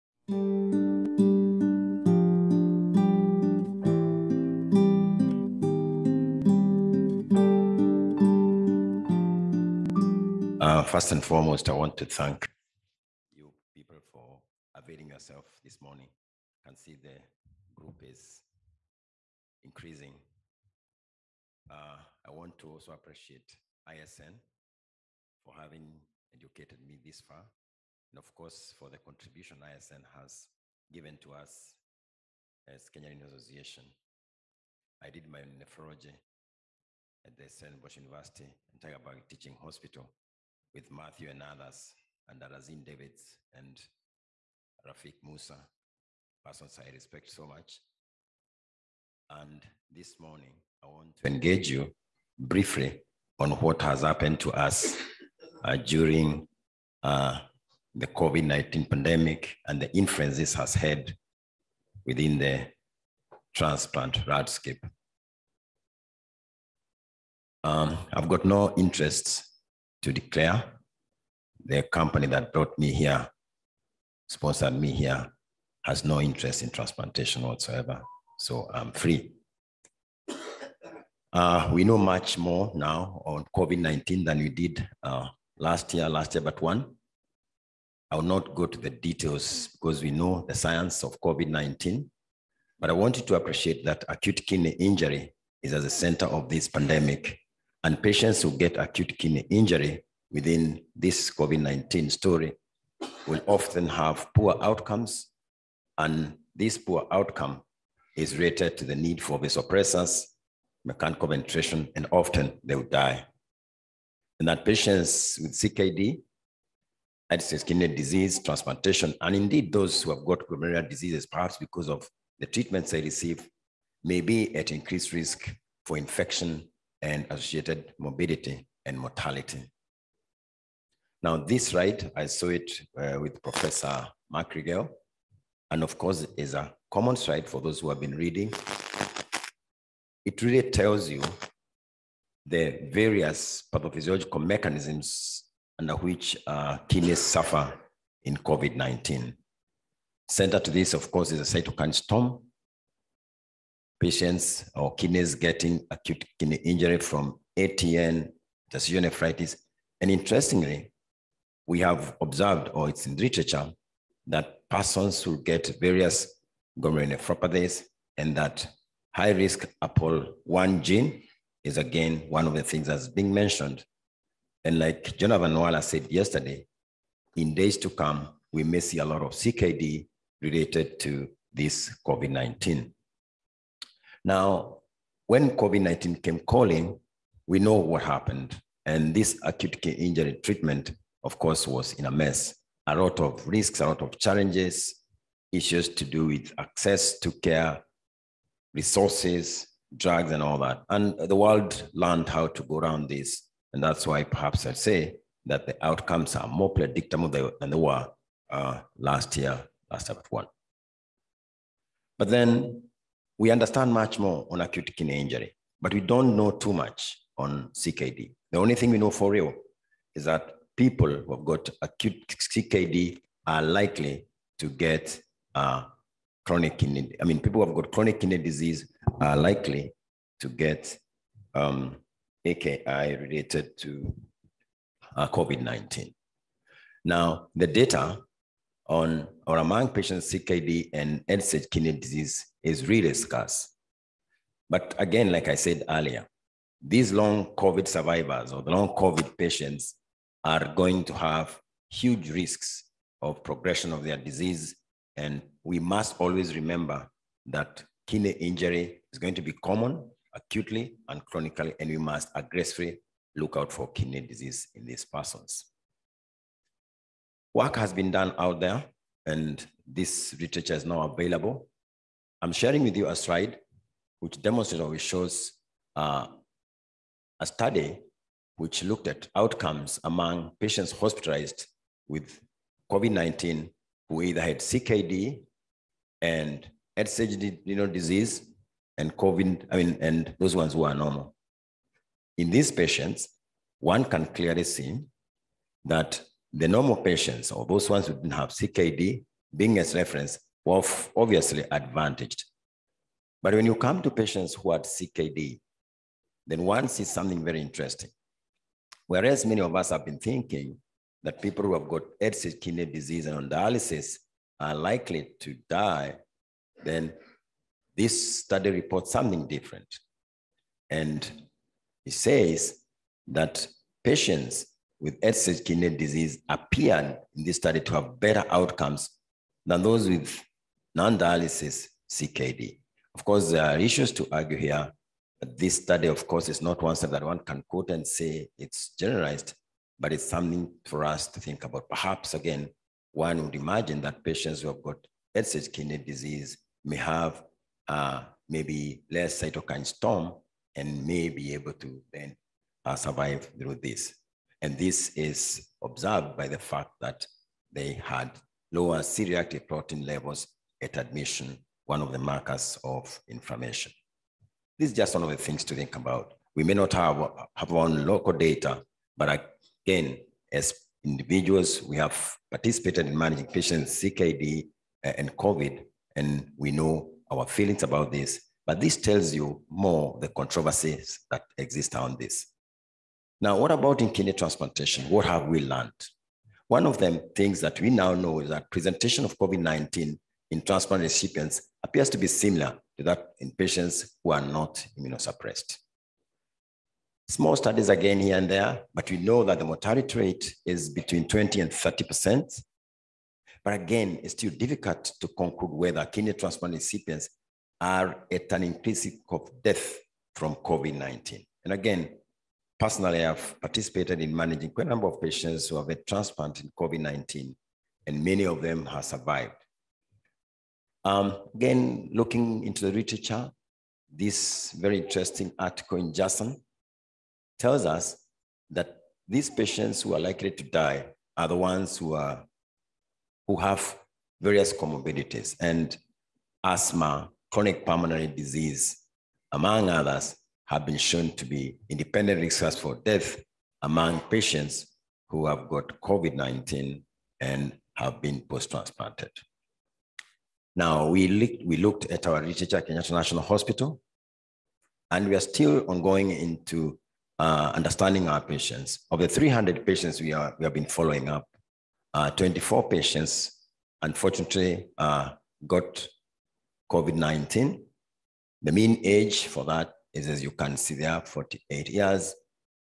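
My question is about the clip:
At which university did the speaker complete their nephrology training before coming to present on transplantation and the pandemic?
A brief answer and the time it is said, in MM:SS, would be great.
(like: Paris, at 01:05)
Stellenbosch University, at 00:37.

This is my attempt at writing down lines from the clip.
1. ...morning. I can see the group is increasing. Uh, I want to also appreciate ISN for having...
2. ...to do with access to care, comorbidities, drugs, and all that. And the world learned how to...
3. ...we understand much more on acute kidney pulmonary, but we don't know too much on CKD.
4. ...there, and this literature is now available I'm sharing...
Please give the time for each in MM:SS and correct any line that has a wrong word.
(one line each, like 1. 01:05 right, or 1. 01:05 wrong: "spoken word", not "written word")
1. 00:15 right
2. 03:15 wrong: "resources", not "comorbidities"
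3. 03:33 wrong: "injury", not "pulmonary"
4. 04:28 right.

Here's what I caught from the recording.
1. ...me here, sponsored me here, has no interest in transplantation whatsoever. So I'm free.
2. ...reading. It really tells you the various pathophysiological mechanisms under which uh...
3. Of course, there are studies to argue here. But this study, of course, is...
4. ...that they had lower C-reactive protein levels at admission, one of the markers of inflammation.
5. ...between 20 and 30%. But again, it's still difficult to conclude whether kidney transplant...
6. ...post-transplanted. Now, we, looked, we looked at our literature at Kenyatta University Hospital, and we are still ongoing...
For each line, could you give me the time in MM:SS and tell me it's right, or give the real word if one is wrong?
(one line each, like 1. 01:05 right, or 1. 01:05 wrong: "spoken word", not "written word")
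1. 01:12 right
2. 02:18 right
3. 05:33 wrong: "issues", not "studies"
4. 05:57 right
5. 06:40 right
6. 07:28 wrong: "National", not "University".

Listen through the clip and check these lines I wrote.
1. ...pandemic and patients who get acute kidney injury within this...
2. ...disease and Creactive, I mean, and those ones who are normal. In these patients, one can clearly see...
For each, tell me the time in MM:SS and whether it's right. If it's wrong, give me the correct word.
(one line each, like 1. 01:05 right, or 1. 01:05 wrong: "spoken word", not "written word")
1. 01:36 right
2. 04:47 wrong: "COVID", not "Creactive".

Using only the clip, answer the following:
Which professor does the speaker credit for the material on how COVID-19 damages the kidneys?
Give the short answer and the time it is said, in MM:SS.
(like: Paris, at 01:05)
Mark Riegel, at 02:13.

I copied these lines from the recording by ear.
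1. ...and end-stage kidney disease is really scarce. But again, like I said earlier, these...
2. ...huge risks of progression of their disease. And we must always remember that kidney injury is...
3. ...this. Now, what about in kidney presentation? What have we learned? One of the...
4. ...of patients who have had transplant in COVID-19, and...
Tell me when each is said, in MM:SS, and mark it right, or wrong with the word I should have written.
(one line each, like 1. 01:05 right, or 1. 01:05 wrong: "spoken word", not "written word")
1. 04:00 right
2. 04:11 right
3. 06:22 wrong: "transplantation", not "presentation"
4. 06:55 right.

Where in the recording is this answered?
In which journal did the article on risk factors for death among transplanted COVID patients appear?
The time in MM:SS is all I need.
07:06.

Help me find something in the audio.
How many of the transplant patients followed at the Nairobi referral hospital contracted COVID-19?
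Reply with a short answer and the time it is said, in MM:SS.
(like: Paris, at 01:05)
24, at 07:42.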